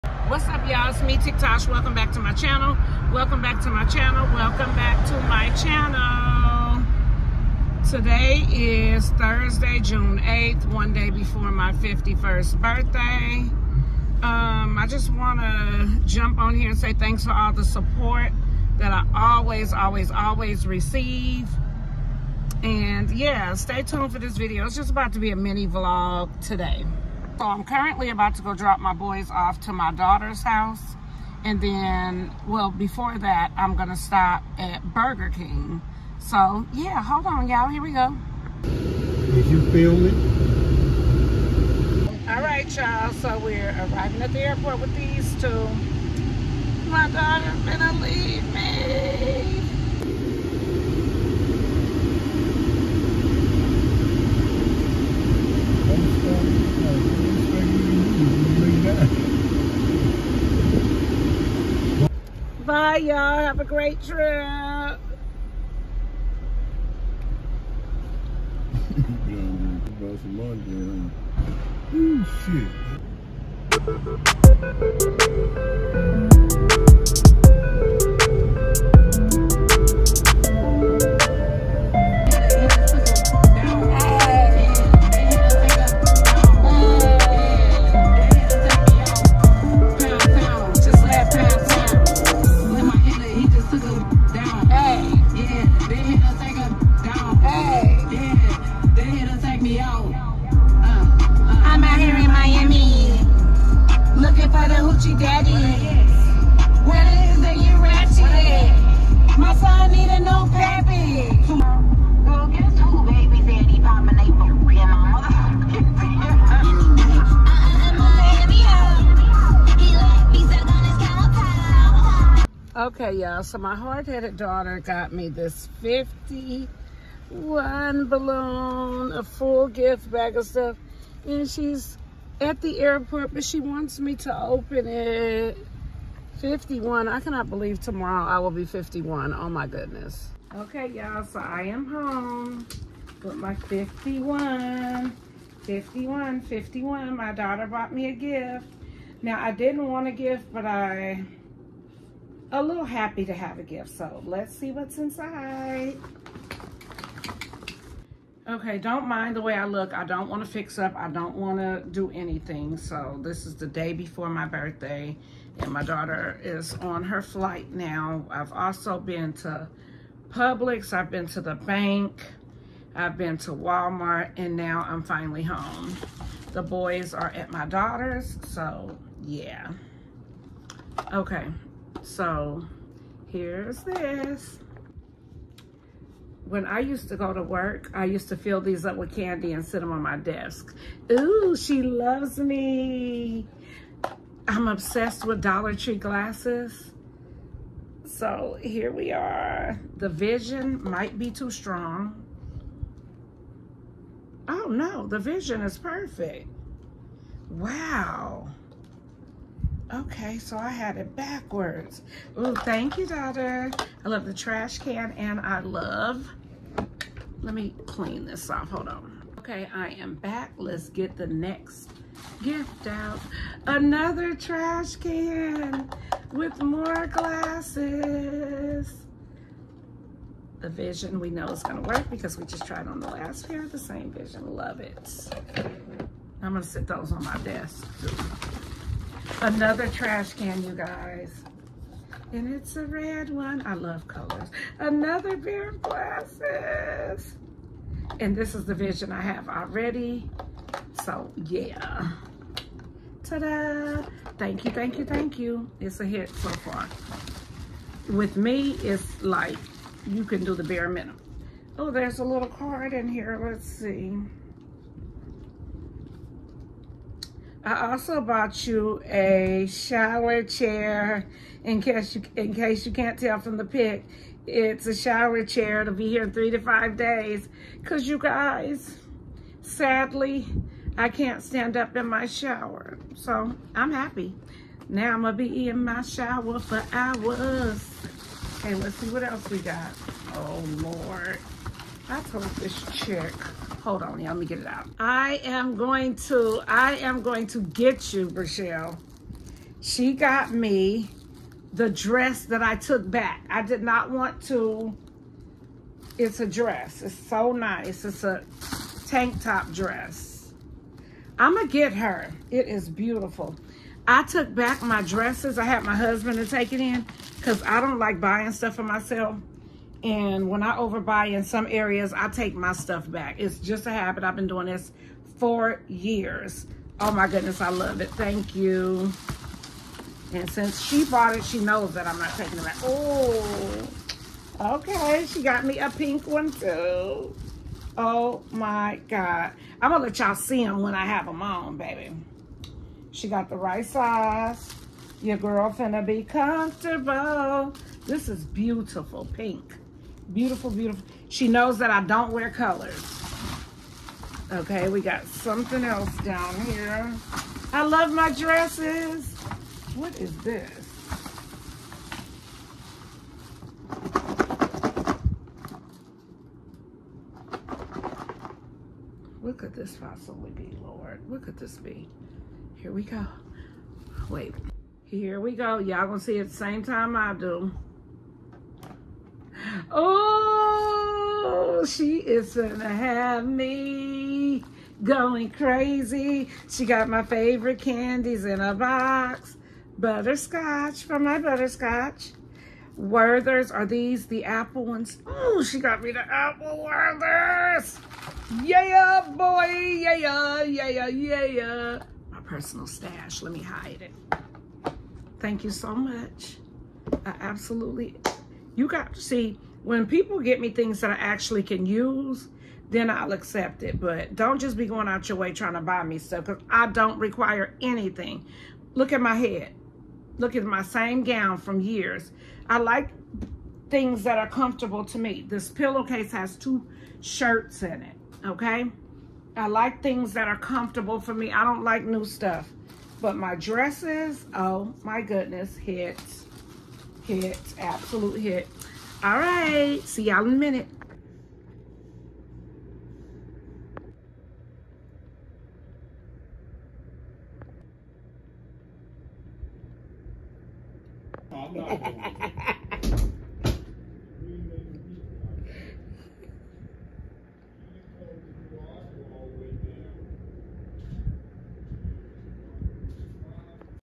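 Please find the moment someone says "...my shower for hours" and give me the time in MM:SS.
04:45.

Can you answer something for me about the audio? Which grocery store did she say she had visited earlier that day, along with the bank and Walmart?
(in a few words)
Publix.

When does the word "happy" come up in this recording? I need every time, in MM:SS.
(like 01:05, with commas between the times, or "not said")
02:32, 04:43.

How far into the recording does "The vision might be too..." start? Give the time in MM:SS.
03:19.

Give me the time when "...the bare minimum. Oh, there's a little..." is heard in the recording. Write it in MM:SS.
04:20.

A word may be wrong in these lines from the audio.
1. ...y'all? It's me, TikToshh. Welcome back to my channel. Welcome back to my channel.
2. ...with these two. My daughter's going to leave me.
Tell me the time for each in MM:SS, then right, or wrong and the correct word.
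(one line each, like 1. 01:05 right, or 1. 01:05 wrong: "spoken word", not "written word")
1. 00:00 right
2. 00:44 right.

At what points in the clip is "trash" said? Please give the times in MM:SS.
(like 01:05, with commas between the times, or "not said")
03:34, 03:44, 03:59.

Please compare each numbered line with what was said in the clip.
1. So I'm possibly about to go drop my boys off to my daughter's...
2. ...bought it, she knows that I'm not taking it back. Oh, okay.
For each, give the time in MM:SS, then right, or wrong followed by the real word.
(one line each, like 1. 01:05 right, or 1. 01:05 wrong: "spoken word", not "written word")
1. 00:27 wrong: "currently", not "possibly"
2. 05:31 right.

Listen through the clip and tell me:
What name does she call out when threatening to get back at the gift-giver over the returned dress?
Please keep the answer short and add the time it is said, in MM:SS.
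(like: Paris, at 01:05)
Rochelle, at 04:58.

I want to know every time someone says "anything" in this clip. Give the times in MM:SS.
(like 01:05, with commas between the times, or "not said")
02:42, 06:57.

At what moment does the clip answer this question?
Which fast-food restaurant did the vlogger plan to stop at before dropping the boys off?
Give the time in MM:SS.
00:34.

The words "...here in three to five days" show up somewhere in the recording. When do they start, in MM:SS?
04:36.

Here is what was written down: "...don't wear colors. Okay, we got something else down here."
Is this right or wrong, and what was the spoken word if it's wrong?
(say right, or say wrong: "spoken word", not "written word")
right.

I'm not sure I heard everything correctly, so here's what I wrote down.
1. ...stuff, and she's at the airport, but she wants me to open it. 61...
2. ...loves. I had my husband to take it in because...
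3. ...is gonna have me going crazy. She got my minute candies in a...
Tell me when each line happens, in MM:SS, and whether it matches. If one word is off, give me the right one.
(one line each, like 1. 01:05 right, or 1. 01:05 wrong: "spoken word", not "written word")
1. 02:10 wrong: "51", not "61"
2. 05:15 wrong: "dresses", not "loves"
3. 06:22 wrong: "favorite", not "minute".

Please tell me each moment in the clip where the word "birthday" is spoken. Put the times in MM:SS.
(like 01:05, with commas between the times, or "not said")
00:12, 02:44.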